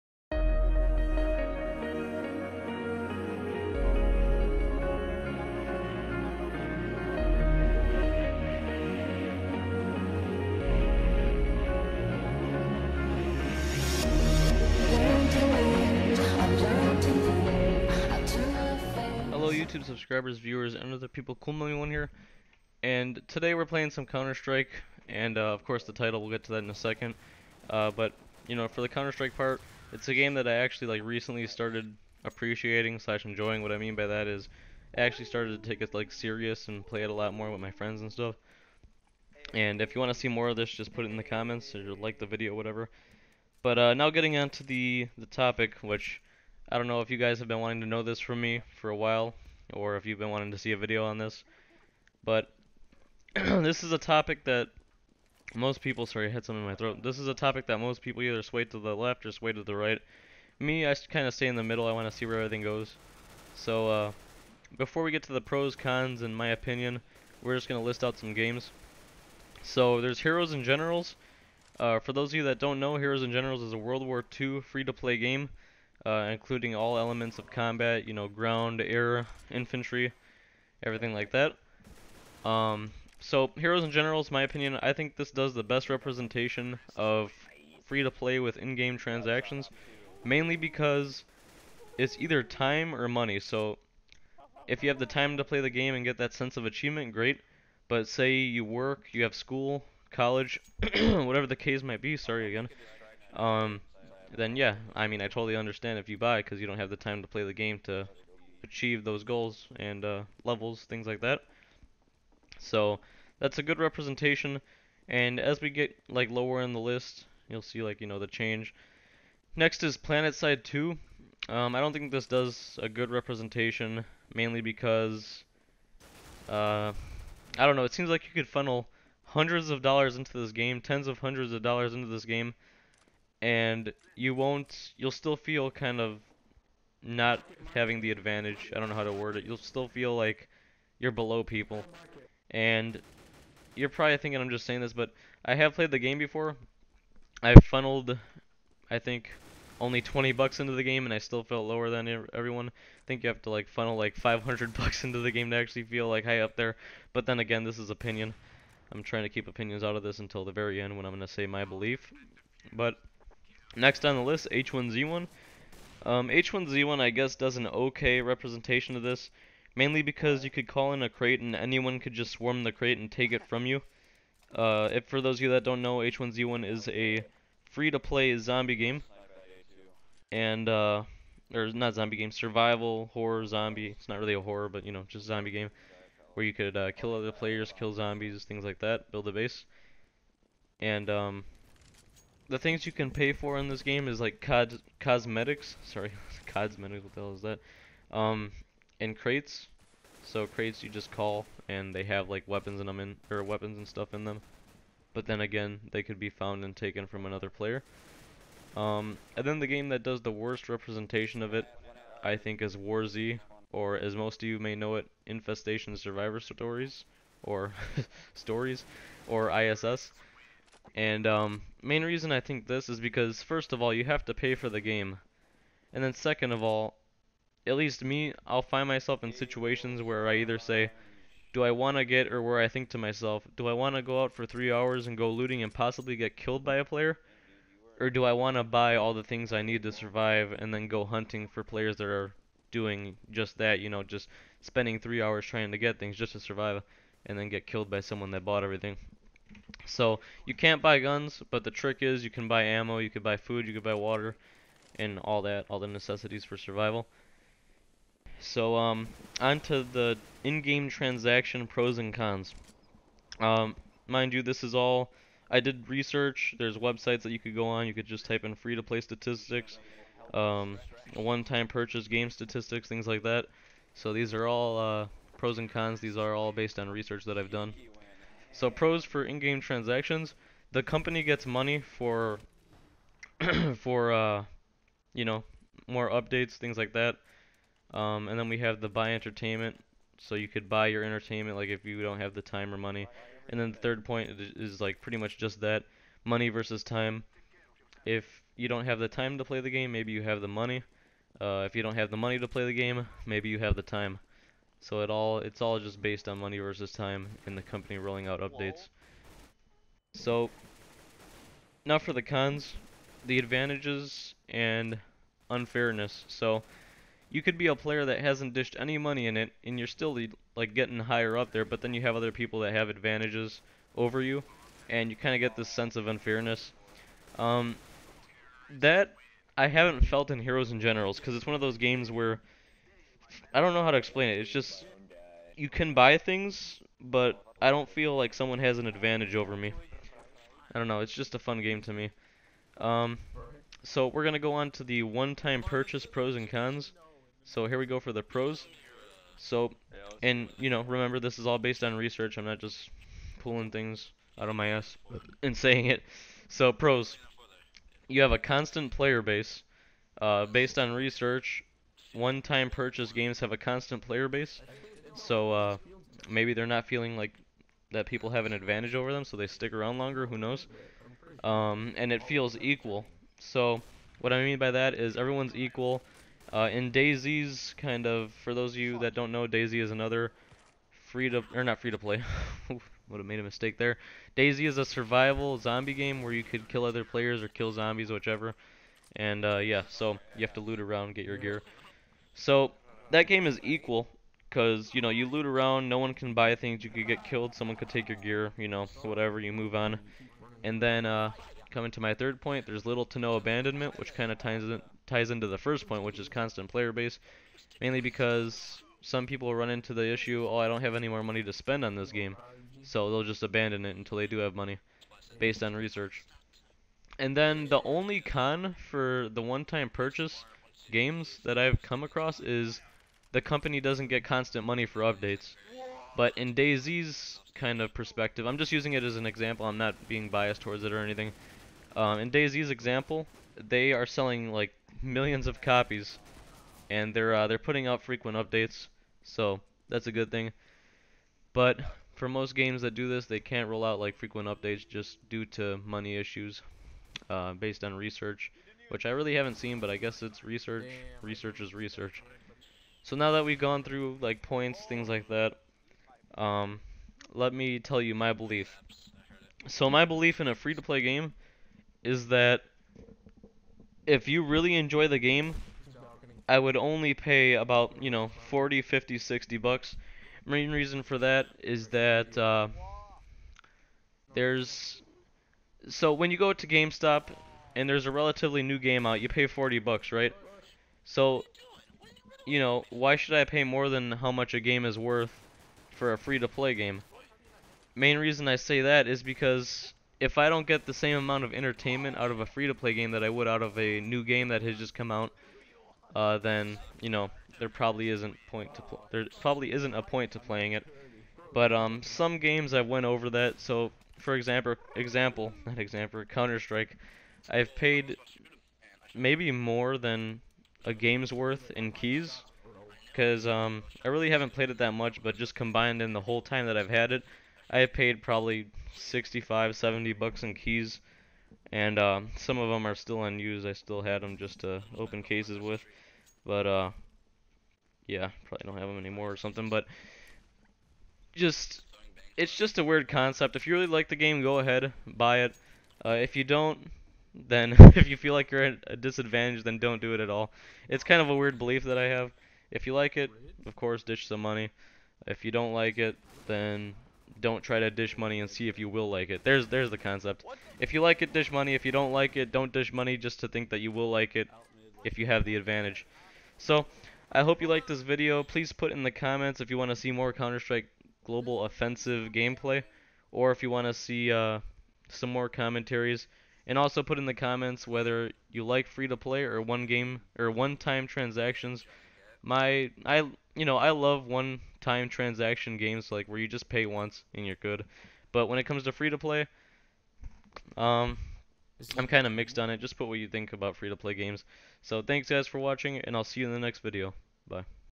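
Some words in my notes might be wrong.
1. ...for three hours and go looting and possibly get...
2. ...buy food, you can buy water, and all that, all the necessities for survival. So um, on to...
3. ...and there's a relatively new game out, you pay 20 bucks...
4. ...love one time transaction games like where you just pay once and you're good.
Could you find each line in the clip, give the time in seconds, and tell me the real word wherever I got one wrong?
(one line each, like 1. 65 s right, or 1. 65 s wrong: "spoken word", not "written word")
1. 234 s right
2. 253 s right
3. 477 s wrong: "40", not "20"
4. 573 s right.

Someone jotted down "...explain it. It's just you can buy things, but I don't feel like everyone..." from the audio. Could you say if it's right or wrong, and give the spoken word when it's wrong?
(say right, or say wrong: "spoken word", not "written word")
wrong: "someone", not "everyone".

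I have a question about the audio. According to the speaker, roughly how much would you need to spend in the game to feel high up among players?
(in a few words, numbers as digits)
$500.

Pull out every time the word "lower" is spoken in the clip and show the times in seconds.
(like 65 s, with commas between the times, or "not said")
116 s, 151 s.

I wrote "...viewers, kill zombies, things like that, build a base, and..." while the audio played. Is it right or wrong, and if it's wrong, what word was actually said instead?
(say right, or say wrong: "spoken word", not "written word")
wrong: "players", not "viewers".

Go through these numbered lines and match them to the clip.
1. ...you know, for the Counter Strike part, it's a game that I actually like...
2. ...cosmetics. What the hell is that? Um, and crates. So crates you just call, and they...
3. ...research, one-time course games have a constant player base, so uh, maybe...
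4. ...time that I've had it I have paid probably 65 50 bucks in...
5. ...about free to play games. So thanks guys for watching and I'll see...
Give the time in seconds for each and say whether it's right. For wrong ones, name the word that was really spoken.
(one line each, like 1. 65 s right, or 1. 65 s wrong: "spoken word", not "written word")
1. 28 s right
2. 196 s right
3. 360 s wrong: "purchase", not "course"
4. 516 s wrong: "70", not "50"
5. 583 s right.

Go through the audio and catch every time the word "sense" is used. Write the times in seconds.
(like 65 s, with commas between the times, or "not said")
96 s, 325 s.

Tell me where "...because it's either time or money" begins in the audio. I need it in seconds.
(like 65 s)
90 s.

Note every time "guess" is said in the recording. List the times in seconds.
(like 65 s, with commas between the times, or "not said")
167 s, 449 s.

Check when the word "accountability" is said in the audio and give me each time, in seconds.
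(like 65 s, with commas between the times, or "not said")
not said.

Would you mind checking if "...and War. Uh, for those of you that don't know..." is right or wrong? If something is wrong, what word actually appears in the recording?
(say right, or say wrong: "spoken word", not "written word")
wrong: "Generals", not "War".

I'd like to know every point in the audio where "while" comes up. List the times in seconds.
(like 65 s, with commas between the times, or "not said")
48 s.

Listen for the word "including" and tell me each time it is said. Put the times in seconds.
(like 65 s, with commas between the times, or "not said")
76 s.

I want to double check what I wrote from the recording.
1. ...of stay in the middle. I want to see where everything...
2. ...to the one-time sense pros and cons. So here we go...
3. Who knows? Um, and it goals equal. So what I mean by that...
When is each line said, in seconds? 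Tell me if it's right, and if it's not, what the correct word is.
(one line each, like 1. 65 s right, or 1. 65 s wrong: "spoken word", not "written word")
1. 61 s right
2. 344 s wrong: "purchase", not "sense"
3. 370 s wrong: "feels", not "goals".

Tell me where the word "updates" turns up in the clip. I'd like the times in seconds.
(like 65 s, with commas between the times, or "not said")
286 s, 308 s, 425 s, 438 s, 444 s.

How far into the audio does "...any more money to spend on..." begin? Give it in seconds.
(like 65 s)
410 s.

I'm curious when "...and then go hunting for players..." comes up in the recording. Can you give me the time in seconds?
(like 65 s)
240 s.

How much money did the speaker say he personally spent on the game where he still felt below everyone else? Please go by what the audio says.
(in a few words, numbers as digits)
$20.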